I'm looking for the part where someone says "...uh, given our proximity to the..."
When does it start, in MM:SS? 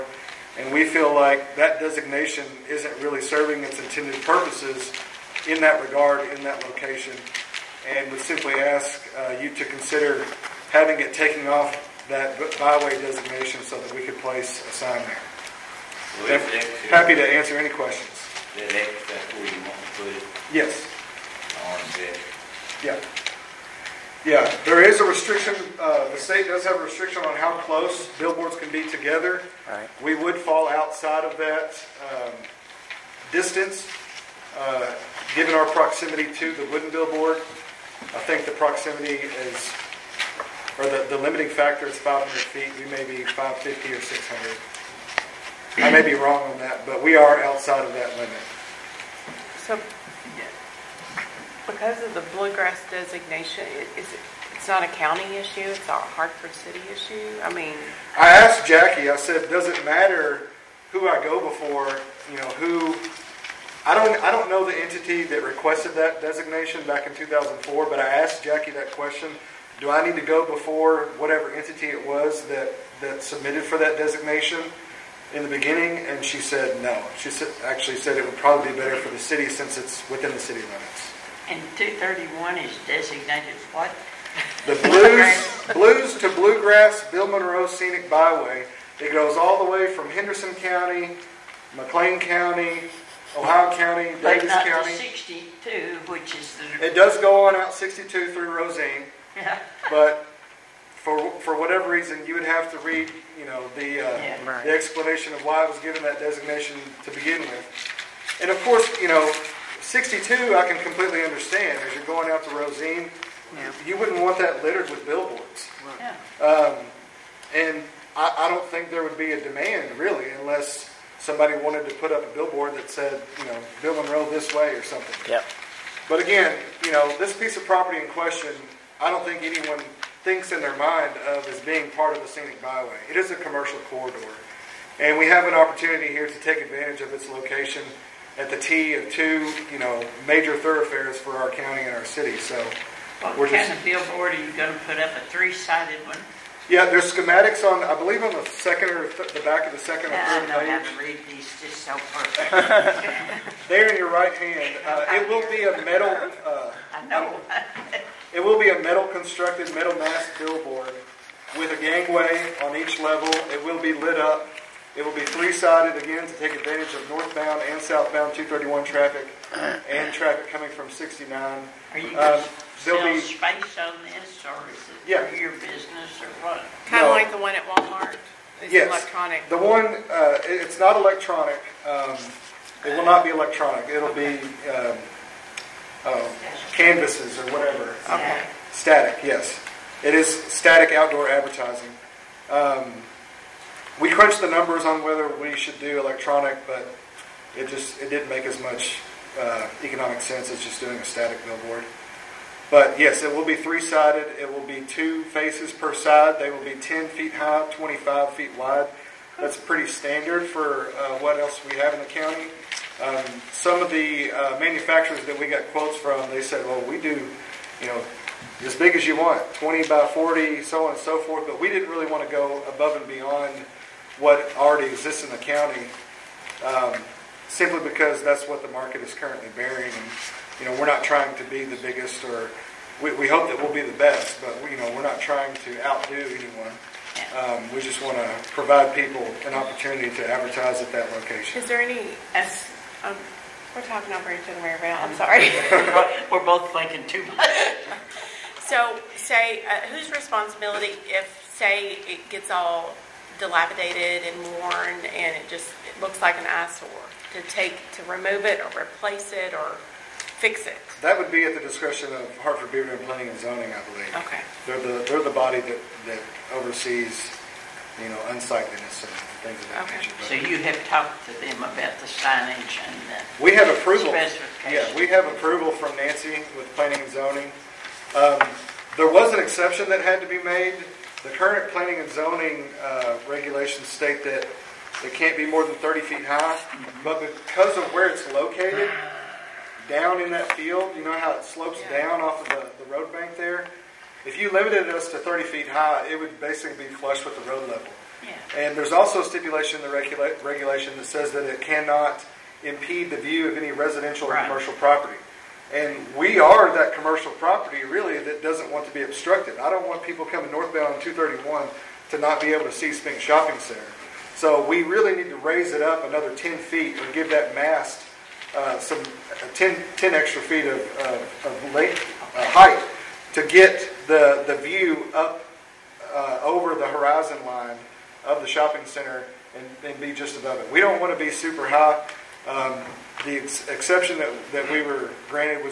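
00:34.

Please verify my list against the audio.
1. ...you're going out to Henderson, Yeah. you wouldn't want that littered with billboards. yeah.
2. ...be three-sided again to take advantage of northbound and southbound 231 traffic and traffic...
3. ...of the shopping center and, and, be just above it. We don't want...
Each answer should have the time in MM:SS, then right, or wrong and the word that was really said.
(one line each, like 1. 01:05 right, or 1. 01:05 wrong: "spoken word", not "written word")
1. 01:51 wrong: "Rosine", not "Henderson"
2. 02:45 right
3. 05:28 right.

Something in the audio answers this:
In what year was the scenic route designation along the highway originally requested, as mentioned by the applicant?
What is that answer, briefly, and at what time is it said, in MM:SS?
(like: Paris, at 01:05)
2004, at 01:07.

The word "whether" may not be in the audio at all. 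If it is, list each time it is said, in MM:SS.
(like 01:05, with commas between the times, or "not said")
03:15.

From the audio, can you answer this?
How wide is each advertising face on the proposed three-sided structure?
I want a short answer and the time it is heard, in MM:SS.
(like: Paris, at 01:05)
25 feet, at 03:27.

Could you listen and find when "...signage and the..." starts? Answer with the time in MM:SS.
04:32.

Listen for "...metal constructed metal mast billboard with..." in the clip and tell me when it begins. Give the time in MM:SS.
02:38.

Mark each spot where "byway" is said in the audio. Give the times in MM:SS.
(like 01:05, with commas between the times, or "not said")
00:12, 01:28, 02:12.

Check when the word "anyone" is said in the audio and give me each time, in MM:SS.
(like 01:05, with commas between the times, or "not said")
02:09, 03:56.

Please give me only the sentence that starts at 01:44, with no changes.
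the explanation of why it was given that designation to begin with.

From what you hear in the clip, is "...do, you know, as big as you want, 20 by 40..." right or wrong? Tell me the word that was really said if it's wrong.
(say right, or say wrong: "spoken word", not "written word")
right.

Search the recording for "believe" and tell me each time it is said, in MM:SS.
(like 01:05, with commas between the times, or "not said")
02:27, 04:23.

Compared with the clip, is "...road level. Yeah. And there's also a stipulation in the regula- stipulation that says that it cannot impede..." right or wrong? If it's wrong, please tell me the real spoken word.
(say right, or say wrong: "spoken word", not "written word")
wrong: "regulation", not "stipulation".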